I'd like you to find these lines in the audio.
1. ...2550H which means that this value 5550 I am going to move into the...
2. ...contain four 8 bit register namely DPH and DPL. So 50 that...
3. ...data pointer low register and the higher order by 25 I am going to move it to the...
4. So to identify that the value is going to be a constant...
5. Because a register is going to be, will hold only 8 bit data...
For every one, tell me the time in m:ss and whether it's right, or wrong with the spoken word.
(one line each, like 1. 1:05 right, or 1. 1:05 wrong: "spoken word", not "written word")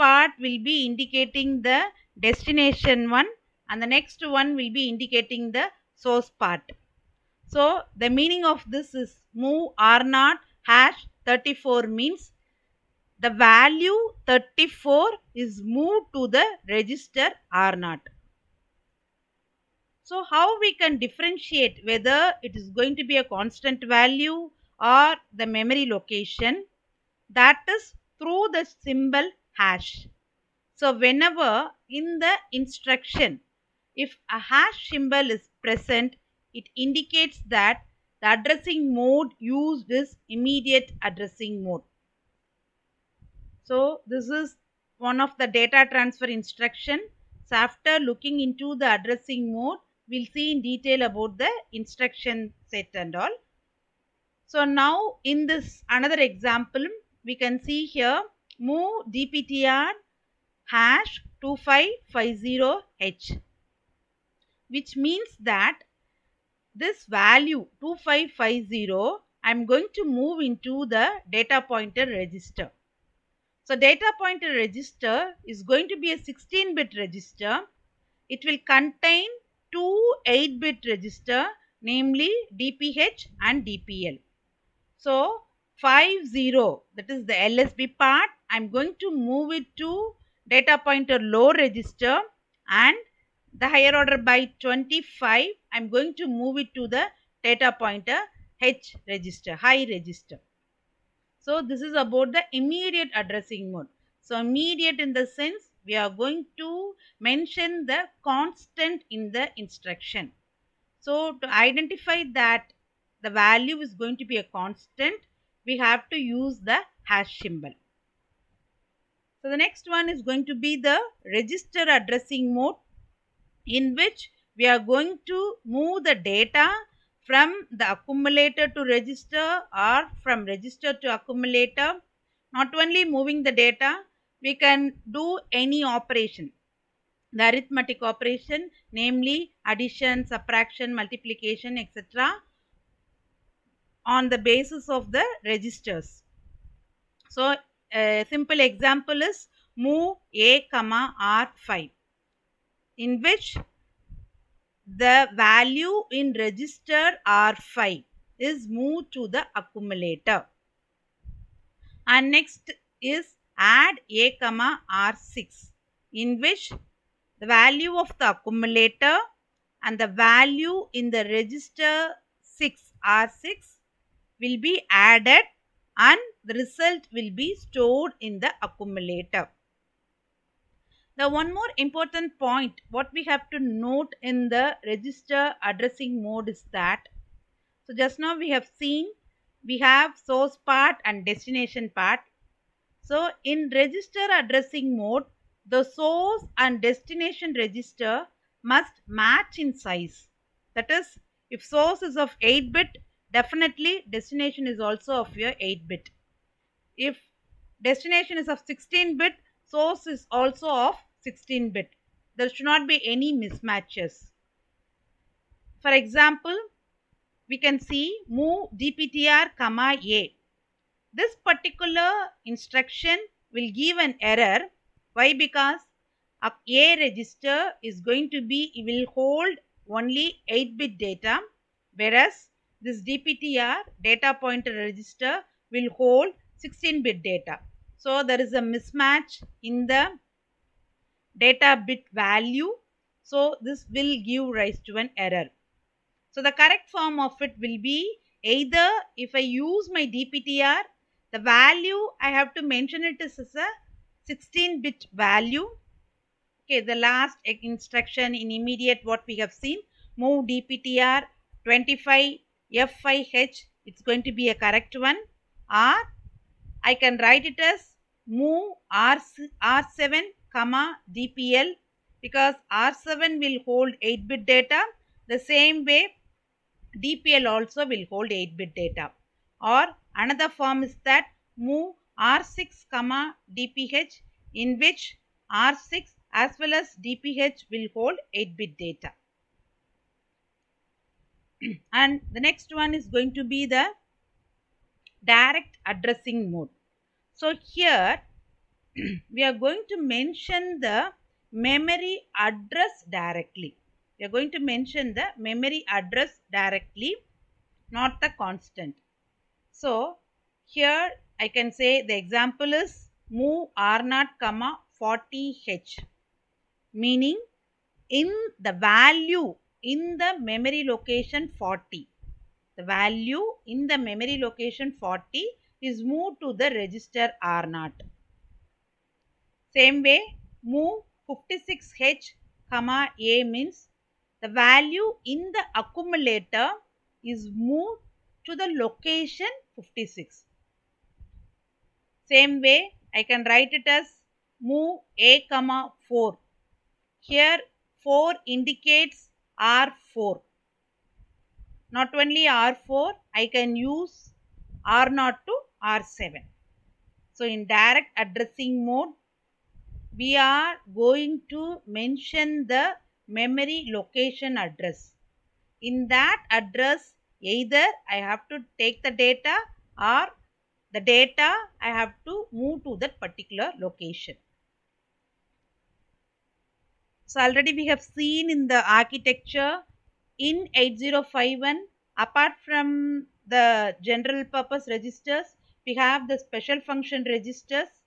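1. 1:01 wrong: "2550", not "5550"
2. 1:18 wrong: "two", not "four"
3. 1:30 right
4. 1:50 right
5. 3:45 right.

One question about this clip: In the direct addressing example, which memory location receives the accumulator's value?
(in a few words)
56H.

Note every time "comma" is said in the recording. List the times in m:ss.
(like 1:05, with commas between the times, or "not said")
2:30, 2:44, 3:39, 4:30, 4:42, 5:14, 5:32, 5:45.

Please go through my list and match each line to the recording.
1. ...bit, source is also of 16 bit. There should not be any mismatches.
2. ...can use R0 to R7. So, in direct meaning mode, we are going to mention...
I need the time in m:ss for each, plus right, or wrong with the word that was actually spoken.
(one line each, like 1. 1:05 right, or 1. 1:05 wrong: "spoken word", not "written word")
1. 3:29 right
2. 5:53 wrong: "addressing", not "meaning".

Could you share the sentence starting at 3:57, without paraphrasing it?
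So there is a mismatch in the data bit value.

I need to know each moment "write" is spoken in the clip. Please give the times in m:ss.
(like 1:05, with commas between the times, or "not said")
4:27, 5:43.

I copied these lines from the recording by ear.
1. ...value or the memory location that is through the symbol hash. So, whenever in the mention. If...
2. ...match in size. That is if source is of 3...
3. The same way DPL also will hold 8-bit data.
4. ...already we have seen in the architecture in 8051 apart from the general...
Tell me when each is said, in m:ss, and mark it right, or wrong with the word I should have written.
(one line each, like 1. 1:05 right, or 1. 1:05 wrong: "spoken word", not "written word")
1. 0:23 wrong: "instruction", not "mention"
2. 3:19 wrong: "8", not "3"
3. 4:35 right
4. 6:17 right.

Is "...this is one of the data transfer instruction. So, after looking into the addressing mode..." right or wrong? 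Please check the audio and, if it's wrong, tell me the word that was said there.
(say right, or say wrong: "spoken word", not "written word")
right.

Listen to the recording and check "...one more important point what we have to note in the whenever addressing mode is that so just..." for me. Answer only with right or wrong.
wrong.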